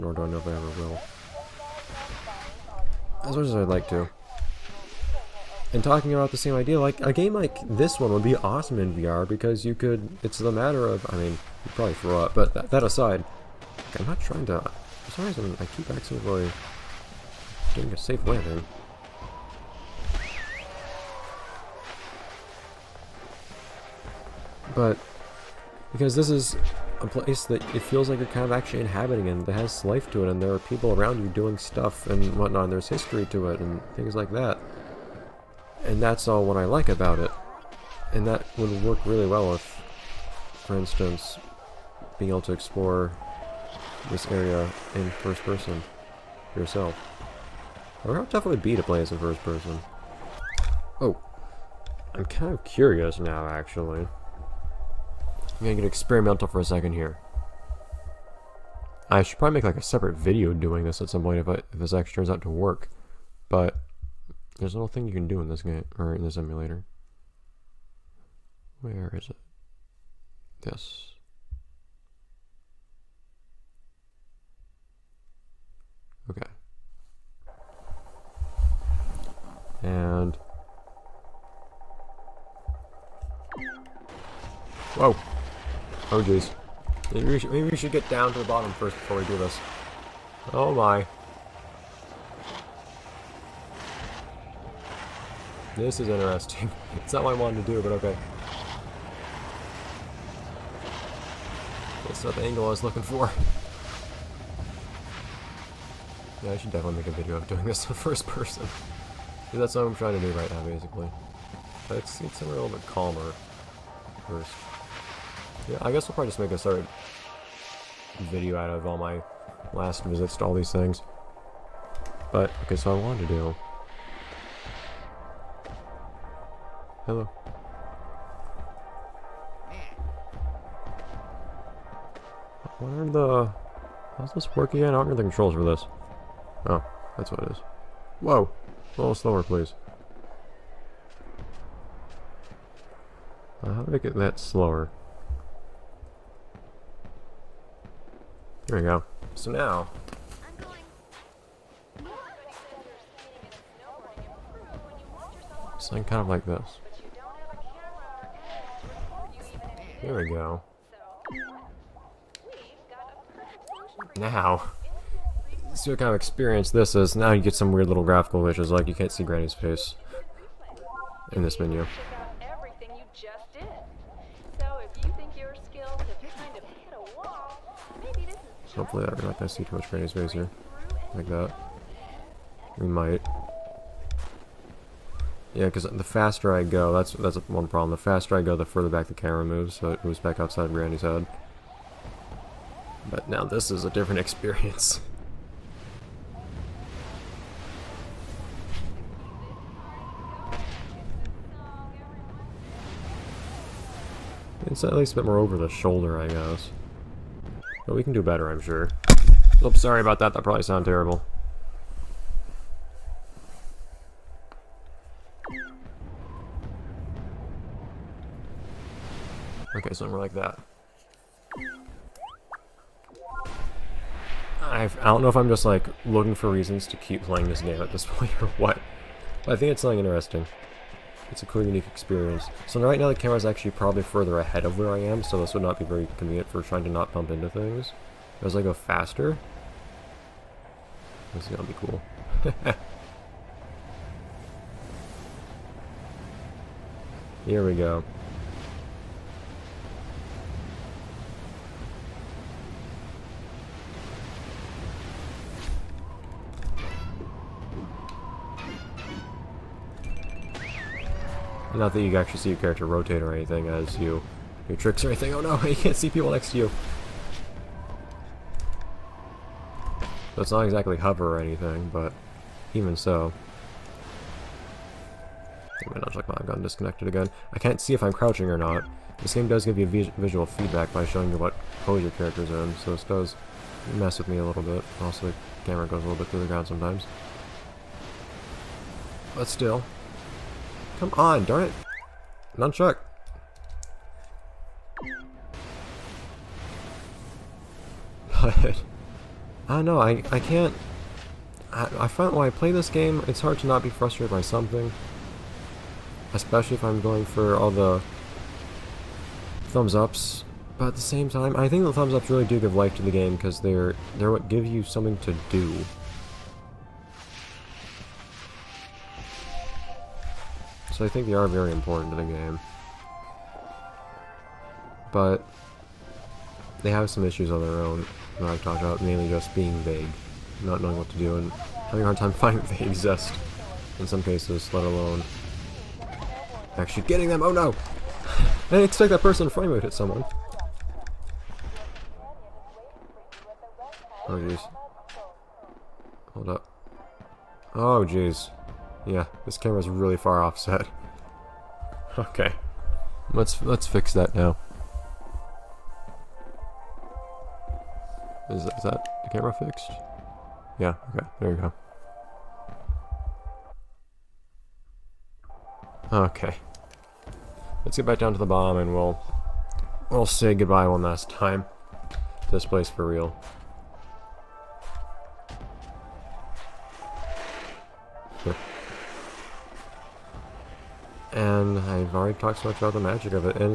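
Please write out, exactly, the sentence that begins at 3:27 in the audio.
But we can do better, I'm sure.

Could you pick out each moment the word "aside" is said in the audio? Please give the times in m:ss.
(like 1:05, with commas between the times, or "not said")
0:12.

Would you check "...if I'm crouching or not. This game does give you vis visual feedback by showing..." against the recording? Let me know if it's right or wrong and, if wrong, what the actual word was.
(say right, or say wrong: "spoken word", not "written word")
right.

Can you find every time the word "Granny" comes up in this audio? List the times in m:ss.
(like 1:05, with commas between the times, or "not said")
2:49, 2:59, 3:10.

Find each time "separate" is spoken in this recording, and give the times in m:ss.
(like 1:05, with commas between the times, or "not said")
0:59, 1:56.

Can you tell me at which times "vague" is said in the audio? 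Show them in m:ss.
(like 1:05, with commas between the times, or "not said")
5:29.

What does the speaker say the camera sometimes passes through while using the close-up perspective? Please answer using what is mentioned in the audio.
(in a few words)
the ground.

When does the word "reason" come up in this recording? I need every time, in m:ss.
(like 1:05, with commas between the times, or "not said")
0:15, 3:46.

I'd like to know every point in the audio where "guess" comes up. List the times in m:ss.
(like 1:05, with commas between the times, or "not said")
1:55, 3:26.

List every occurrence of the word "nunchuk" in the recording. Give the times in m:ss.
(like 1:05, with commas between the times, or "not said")
4:36, 4:52.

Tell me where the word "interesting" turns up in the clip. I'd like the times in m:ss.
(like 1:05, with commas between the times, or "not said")
1:36, 3:50.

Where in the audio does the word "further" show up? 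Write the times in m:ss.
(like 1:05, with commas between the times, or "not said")
3:08, 3:54.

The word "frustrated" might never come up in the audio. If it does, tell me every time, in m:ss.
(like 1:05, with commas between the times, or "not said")
5:03.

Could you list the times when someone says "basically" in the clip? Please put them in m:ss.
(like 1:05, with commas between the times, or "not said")
1:50.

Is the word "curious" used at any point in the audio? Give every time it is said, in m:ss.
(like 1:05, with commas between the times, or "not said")
0:52.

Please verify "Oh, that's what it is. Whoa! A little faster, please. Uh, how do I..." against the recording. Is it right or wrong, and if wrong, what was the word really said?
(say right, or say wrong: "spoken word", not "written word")
wrong: "slower", not "faster".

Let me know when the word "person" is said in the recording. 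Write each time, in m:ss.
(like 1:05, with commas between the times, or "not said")
0:45, 0:49, 1:48, 5:39.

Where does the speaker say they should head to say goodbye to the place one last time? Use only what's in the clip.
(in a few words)
the bomb.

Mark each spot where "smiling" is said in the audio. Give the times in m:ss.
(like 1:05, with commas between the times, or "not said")
not said.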